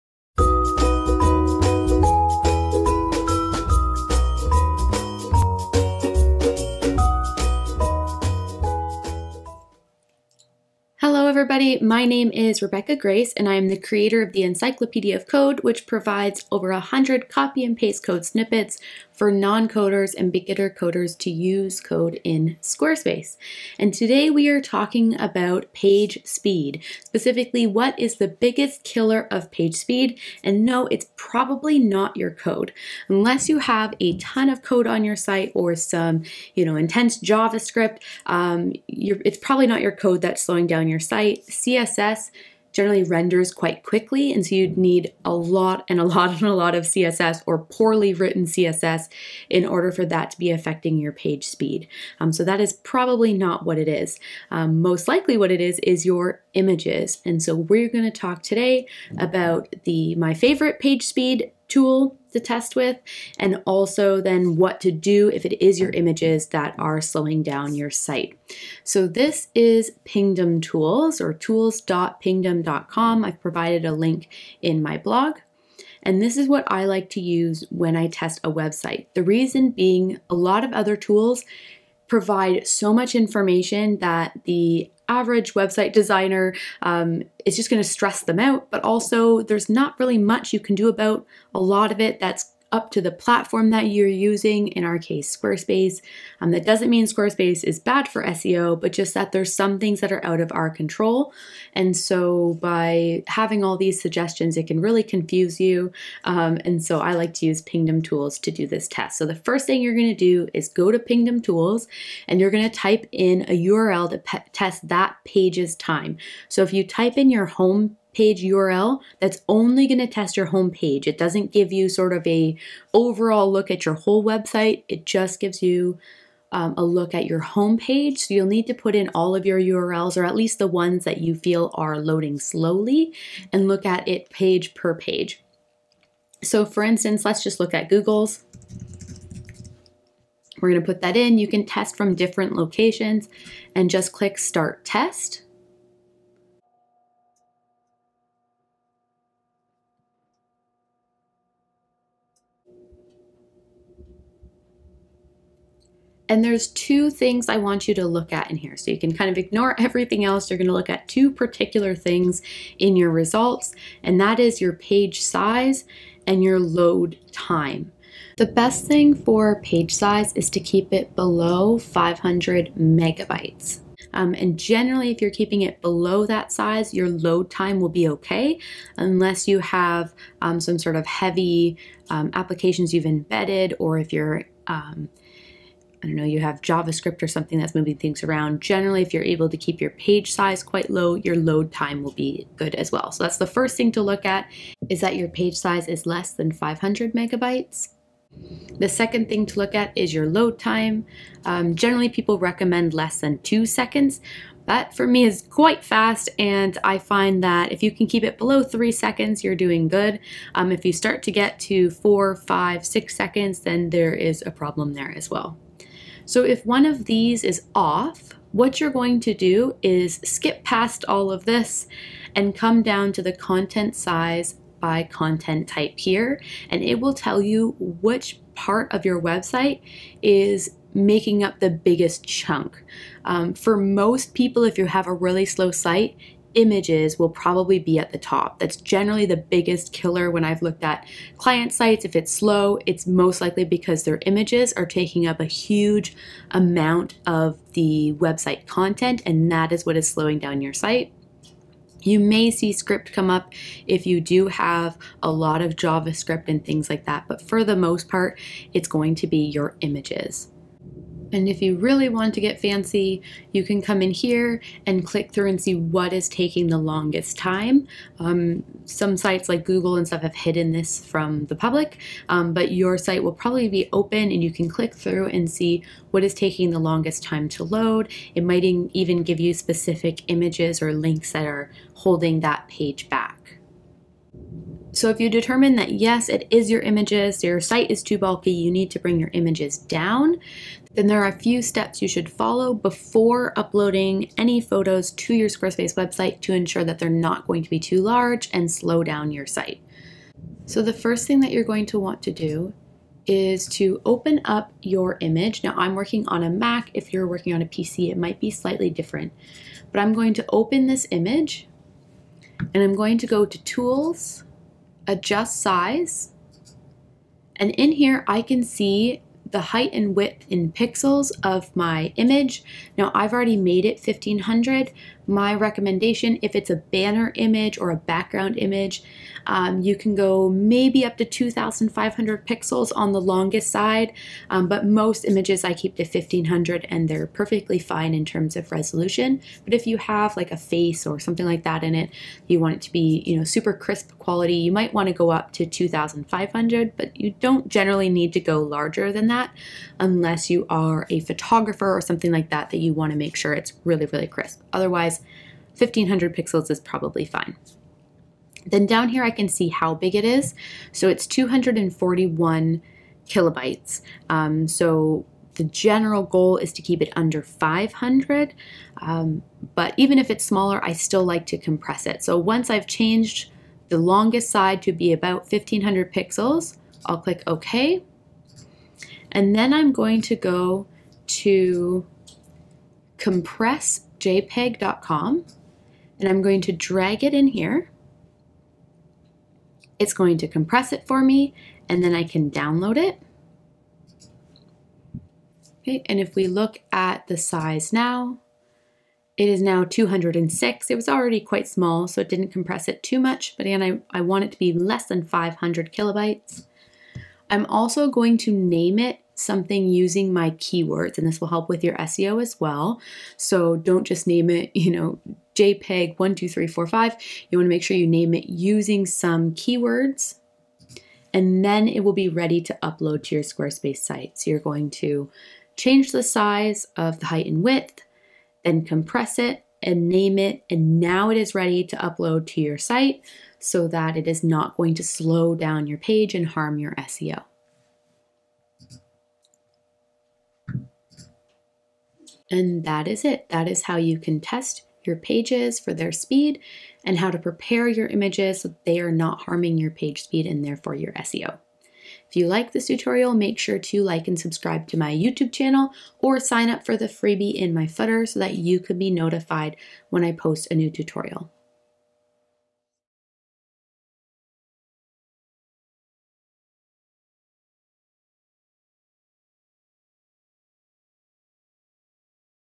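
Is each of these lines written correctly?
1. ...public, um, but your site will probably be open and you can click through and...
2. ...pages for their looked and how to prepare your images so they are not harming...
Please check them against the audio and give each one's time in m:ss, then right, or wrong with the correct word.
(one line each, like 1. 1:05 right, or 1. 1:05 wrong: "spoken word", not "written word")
1. 4:31 right
2. 7:25 wrong: "speed", not "looked".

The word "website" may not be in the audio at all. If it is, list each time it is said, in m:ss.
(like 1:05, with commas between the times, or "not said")
1:18, 1:25, 2:04, 3:49, 4:08, 4:55.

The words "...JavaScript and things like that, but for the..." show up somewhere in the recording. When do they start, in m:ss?
4:15.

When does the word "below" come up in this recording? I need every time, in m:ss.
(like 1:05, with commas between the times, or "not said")
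2:51, 2:55, 3:28.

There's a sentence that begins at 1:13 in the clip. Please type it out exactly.
I've provided a link in my blog.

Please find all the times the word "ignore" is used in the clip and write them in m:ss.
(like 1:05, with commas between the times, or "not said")
2:39.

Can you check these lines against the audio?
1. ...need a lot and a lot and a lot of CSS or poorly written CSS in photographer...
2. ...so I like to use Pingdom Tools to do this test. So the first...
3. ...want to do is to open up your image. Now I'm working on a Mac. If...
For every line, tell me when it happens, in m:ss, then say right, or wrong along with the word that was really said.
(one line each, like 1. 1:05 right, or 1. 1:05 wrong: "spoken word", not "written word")
1. 0:44 wrong: "order", not "photographer"
2. 1:46 right
3. 5:01 right.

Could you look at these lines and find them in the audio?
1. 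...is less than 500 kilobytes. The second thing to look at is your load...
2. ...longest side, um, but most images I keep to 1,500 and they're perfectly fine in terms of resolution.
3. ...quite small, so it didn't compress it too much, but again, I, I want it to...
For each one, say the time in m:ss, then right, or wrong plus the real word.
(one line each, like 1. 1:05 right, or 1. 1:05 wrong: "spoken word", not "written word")
1. 3:15 wrong: "megabytes", not "kilobytes"
2. 5:33 right
3. 6:41 right.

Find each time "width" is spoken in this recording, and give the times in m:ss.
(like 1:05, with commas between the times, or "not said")
5:20, 7:07.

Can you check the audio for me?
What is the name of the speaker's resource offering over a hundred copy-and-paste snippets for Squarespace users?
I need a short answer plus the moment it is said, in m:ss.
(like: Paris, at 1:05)
Encyclopedia of Code, at 0:14.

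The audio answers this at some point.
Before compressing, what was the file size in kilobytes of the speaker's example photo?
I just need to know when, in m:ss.
6:01.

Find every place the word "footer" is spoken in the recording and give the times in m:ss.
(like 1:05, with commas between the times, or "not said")
7:37.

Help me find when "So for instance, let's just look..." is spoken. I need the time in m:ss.
2:16.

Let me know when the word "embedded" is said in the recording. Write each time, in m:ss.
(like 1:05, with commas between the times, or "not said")
3:03.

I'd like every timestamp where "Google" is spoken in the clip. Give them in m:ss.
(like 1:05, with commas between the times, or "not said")
2:17, 4:29.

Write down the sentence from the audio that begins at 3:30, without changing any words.
Um, if you start to get to four, five, six seconds, then there is a problem there as well.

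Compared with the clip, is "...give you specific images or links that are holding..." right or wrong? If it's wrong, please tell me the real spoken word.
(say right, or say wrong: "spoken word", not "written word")
right.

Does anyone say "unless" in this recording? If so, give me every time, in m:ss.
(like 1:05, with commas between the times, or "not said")
0:33, 2:58, 5:49.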